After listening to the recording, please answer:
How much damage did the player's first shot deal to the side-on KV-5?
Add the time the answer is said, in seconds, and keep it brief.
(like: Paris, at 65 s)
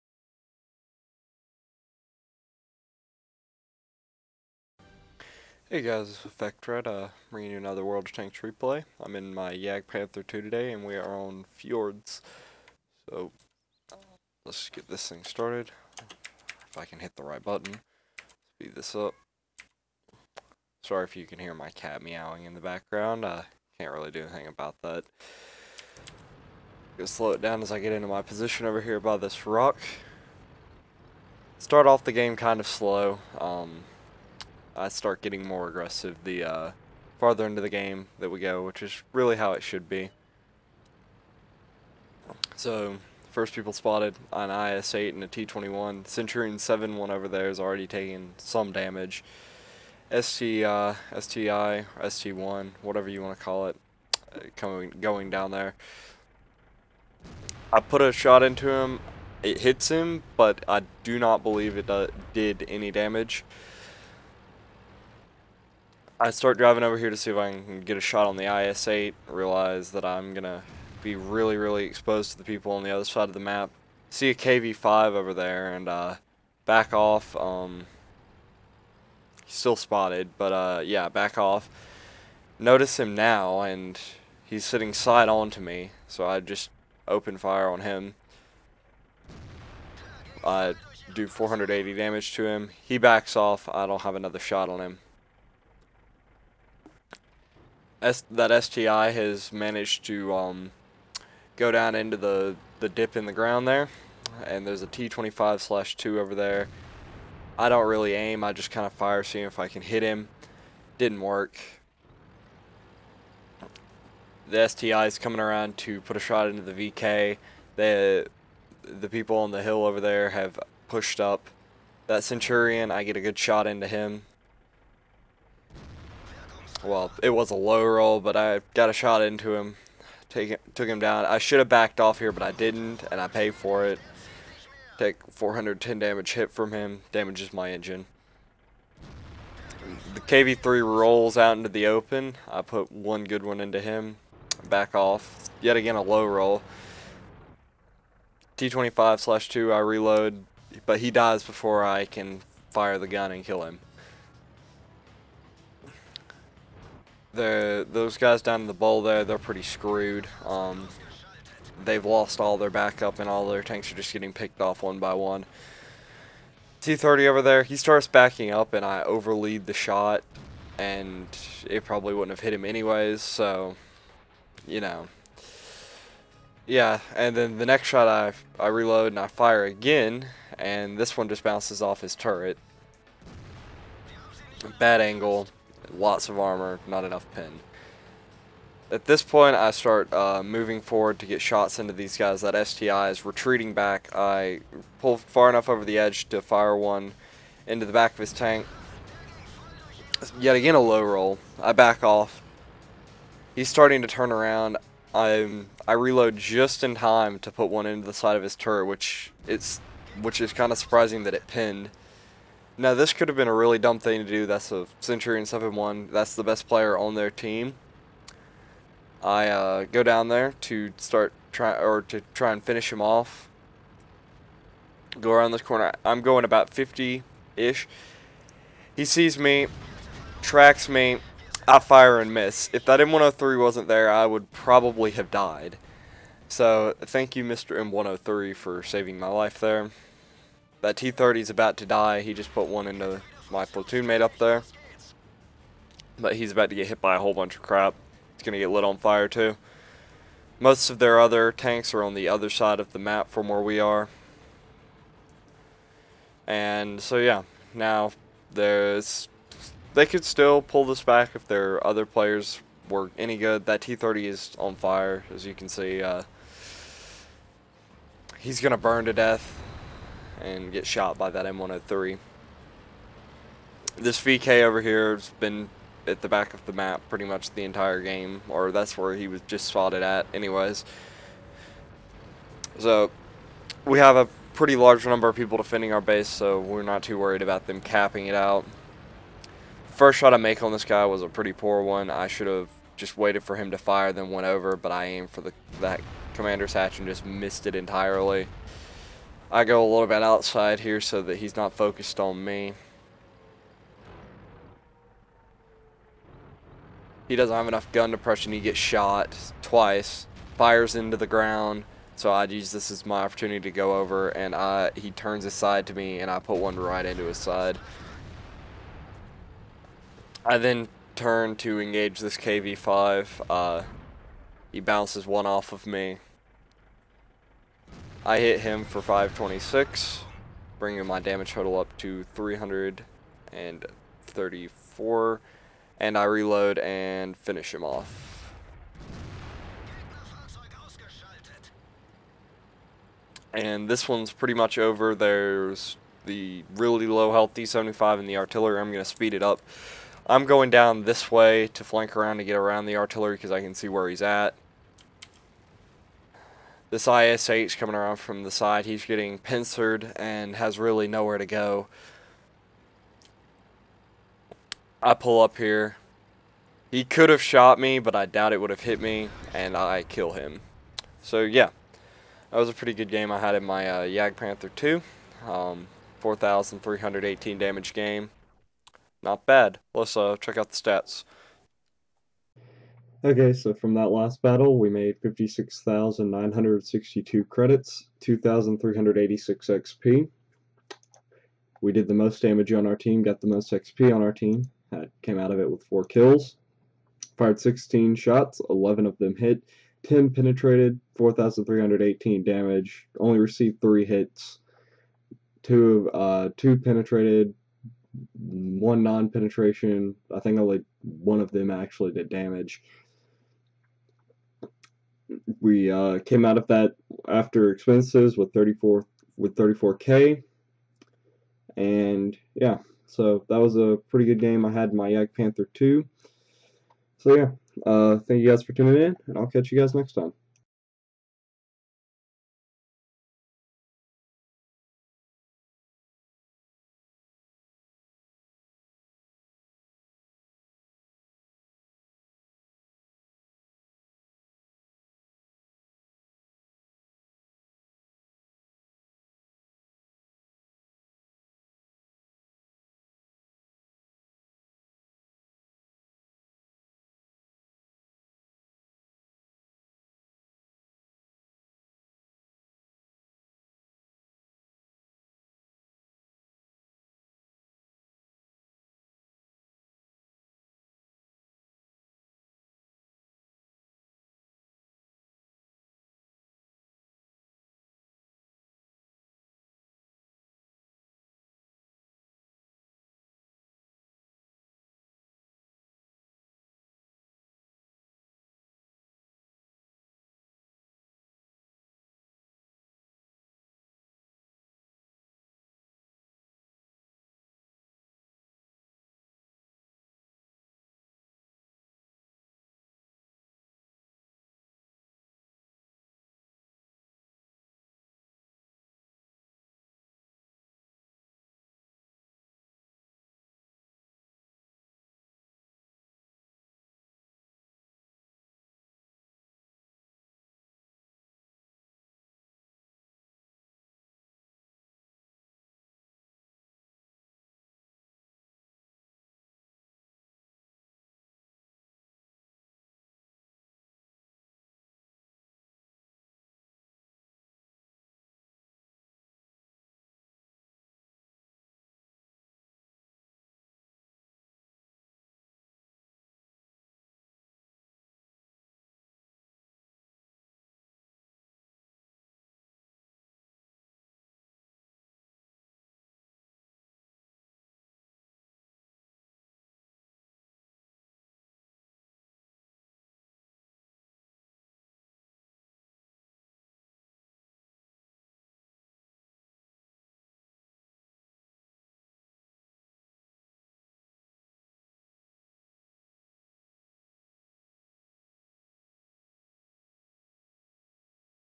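480, at 91 s.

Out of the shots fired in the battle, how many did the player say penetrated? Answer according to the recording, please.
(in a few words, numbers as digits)
10.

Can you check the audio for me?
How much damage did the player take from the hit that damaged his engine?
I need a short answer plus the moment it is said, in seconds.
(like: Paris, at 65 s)
410, at 135 s.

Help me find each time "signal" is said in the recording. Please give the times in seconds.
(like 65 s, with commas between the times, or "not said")
not said.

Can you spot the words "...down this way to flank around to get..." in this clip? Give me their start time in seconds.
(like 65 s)
350 s.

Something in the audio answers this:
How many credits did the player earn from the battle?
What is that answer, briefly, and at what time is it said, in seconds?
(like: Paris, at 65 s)
56,962, at 385 s.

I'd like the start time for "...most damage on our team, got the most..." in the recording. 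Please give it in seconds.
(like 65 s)
392 s.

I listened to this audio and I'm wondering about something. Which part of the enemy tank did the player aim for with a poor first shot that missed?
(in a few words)
commander's hatch.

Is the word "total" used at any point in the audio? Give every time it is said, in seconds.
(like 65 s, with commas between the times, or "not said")
331 s.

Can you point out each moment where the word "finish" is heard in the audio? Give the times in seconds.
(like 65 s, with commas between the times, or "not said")
222 s, 337 s.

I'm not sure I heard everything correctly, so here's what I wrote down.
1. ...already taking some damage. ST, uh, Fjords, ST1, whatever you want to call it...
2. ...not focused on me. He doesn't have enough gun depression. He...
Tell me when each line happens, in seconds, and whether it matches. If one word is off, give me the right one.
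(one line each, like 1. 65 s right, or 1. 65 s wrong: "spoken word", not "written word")
1. 47 s wrong: "STI", not "Fjords"
2. 301 s right.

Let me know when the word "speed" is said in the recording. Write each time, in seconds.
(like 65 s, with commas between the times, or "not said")
18 s, 349 s.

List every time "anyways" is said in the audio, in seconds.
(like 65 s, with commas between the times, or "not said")
172 s, 280 s.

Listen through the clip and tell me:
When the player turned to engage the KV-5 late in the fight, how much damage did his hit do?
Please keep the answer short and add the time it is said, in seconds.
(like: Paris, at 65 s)
526, at 329 s.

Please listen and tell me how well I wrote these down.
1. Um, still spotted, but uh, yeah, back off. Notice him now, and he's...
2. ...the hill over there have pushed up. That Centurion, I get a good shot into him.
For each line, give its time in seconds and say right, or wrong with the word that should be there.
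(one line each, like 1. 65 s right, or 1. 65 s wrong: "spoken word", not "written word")
1. 77 s right
2. 119 s right.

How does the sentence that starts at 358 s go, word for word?
He's getting pincered and has really nowhere to go.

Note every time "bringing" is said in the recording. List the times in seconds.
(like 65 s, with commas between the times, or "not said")
7 s, 330 s.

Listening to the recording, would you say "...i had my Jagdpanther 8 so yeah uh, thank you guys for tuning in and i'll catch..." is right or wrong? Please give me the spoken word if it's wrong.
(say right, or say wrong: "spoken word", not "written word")
wrong: "2", not "8".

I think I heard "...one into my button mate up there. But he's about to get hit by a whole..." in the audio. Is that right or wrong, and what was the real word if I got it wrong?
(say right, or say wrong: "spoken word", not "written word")
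wrong: "platoon", not "button".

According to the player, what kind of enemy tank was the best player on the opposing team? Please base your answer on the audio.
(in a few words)
Centurion 7-1.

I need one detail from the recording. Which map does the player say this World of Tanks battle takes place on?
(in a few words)
Fjords.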